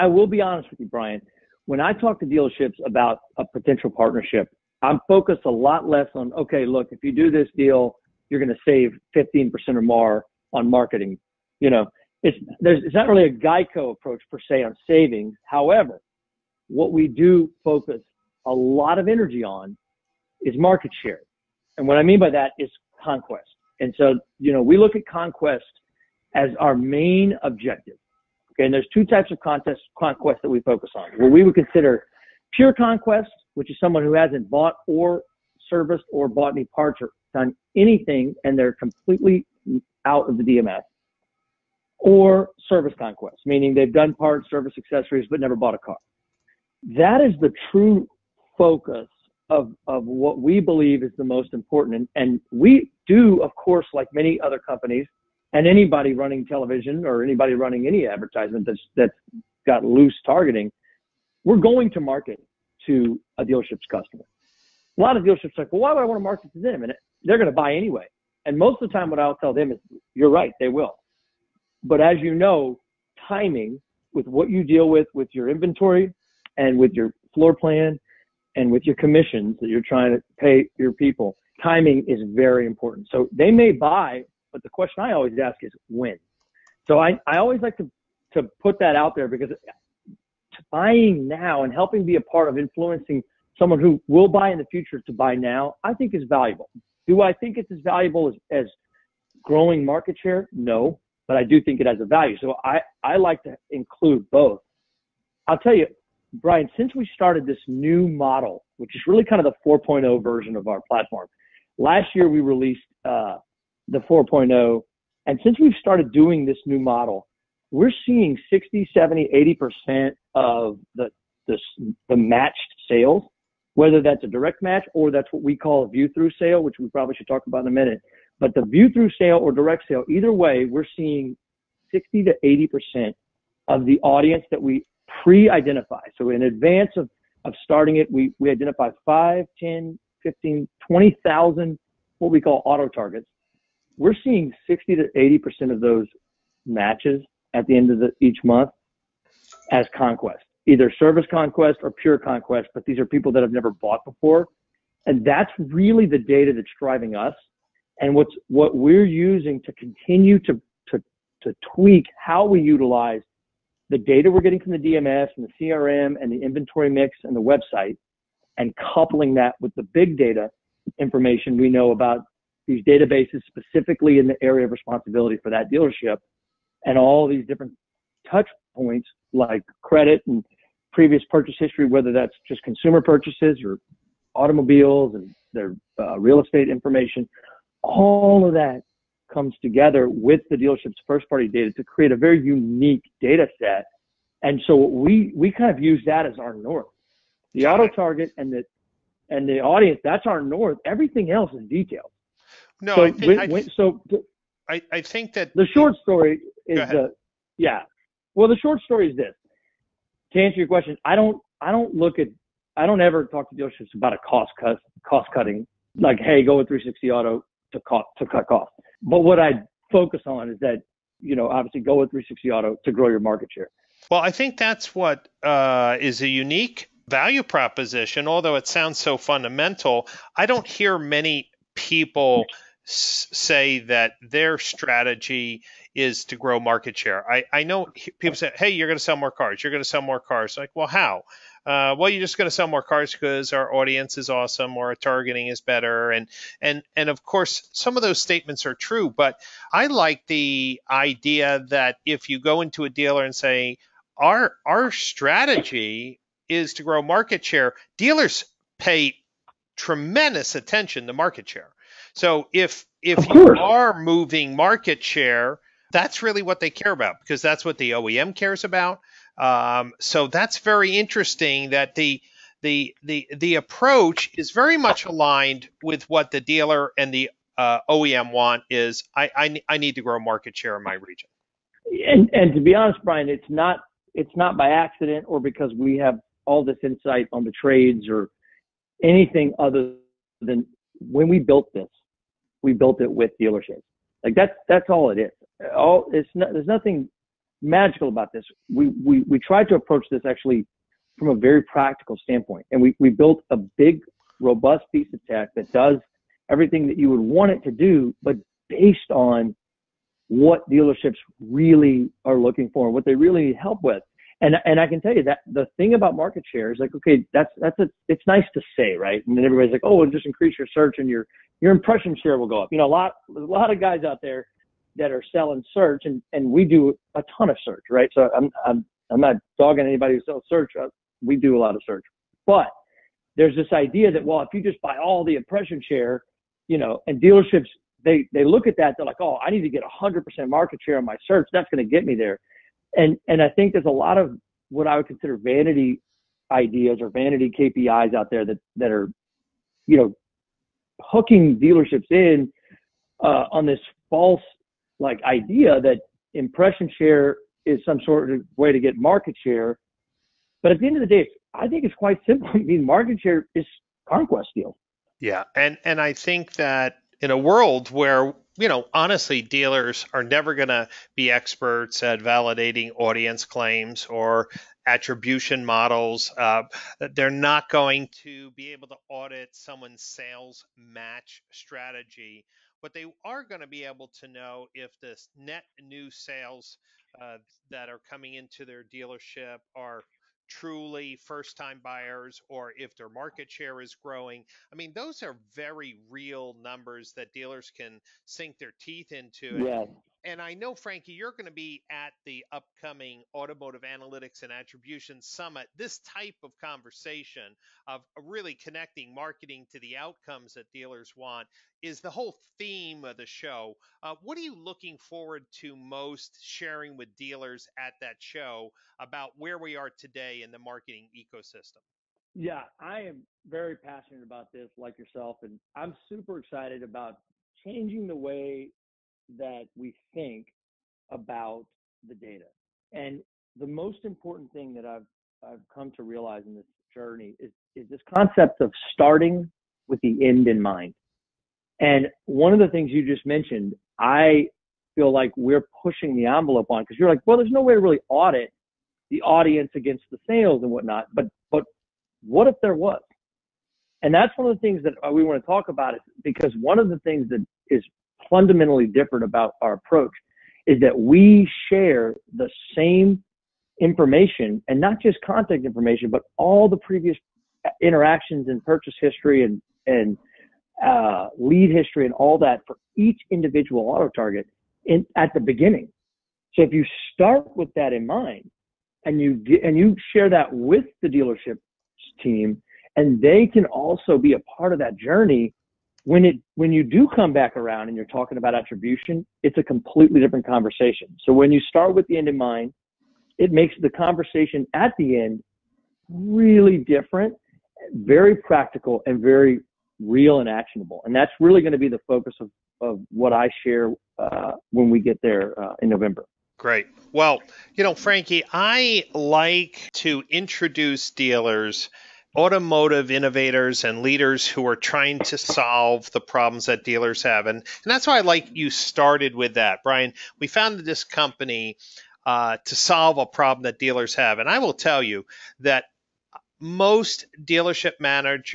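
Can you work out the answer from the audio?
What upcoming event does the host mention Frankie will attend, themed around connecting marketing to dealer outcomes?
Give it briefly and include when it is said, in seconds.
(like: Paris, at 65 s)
Automotive Analytics and Attribution Summit, at 403 s.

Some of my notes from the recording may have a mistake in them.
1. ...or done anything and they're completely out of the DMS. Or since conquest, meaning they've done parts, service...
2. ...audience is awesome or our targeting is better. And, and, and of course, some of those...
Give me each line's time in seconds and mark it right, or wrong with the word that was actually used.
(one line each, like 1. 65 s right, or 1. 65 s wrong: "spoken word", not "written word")
1. 37 s wrong: "service", not "since"
2. 243 s right.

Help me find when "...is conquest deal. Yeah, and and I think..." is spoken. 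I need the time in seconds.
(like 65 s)
363 s.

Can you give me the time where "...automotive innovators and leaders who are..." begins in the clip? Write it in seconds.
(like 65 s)
512 s.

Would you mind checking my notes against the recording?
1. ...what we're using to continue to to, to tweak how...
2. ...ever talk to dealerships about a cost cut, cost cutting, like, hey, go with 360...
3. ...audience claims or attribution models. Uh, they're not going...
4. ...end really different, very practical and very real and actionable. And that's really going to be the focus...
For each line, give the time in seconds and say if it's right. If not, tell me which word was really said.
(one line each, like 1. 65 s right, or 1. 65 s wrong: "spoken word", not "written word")
1. 158 s right
2. 213 s right
3. 372 s right
4. 495 s right.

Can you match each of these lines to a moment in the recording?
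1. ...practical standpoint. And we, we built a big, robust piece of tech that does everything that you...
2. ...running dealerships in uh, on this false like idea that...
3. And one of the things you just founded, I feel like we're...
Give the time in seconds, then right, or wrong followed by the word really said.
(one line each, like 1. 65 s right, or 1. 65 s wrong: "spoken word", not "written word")
1. 301 s right
2. 351 s wrong: "hooking", not "running"
3. 441 s wrong: "mentioned", not "founded".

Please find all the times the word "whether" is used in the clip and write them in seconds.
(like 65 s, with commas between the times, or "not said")
123 s, 181 s.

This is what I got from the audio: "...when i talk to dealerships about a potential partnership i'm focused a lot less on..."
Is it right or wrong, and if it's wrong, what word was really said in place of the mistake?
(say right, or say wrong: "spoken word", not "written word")
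right.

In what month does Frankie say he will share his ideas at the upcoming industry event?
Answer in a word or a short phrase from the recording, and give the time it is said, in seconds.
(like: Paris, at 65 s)
November, at 505 s.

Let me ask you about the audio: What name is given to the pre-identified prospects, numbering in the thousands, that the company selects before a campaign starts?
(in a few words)
Auto targets.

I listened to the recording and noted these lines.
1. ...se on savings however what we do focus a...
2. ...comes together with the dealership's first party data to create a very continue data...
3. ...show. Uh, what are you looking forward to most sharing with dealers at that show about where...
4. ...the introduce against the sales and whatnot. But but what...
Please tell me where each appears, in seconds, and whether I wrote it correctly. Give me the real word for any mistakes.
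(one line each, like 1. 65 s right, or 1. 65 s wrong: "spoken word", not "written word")
1. 14 s right
2. 189 s wrong: "unique", not "continue"
3. 413 s right
4. 449 s wrong: "audience", not "introduce".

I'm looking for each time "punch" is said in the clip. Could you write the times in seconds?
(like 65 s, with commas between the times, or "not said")
not said.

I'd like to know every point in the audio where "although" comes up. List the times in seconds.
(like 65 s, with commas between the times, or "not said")
228 s.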